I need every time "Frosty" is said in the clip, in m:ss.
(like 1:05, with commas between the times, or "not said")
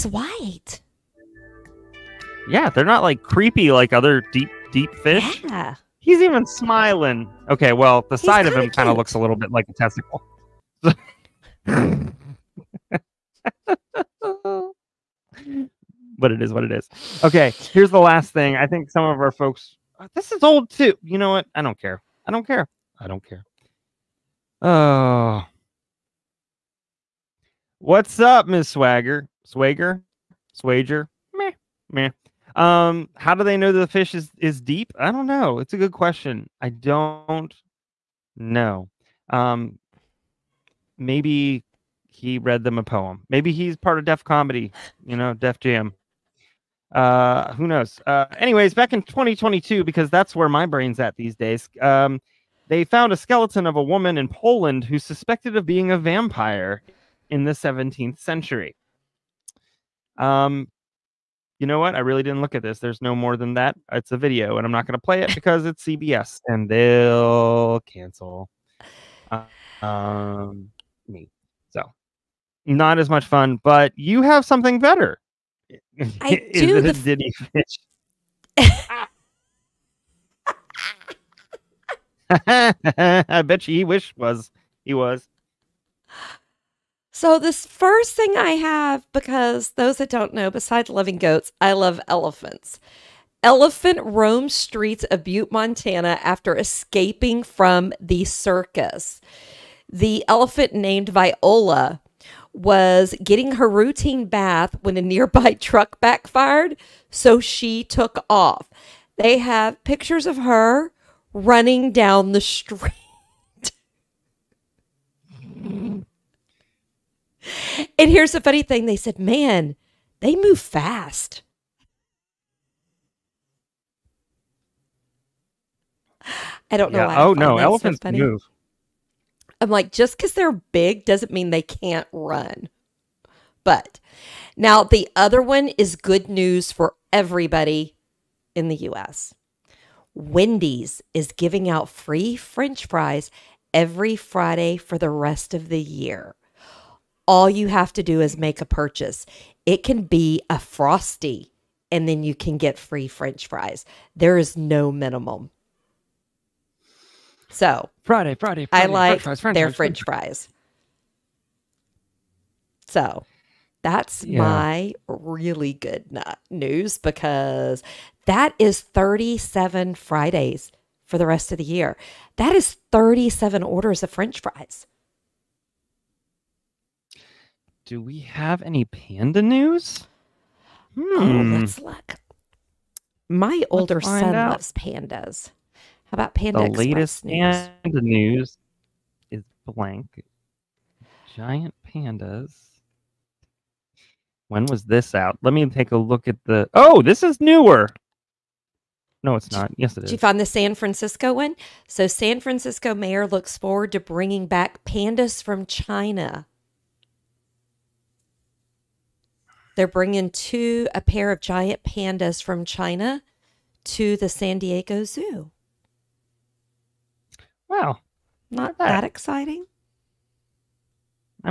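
2:30.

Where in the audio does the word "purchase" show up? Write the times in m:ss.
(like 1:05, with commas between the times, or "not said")
2:28.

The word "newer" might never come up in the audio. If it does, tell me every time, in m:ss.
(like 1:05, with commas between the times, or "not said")
3:17.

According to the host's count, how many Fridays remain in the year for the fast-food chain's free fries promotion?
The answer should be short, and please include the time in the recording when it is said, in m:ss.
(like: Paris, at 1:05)
37, at 2:48.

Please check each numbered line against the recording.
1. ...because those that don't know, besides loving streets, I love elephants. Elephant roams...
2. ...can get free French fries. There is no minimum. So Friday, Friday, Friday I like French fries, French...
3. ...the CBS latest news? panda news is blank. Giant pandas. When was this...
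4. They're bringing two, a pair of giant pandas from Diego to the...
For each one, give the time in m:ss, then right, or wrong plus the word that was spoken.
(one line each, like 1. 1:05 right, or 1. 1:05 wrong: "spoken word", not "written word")
1. 1:29 wrong: "goats", not "streets"
2. 2:32 right
3. 3:06 wrong: "Express", not "CBS"
4. 3:29 wrong: "China", not "Diego".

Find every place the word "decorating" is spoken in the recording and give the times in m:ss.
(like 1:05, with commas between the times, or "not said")
not said.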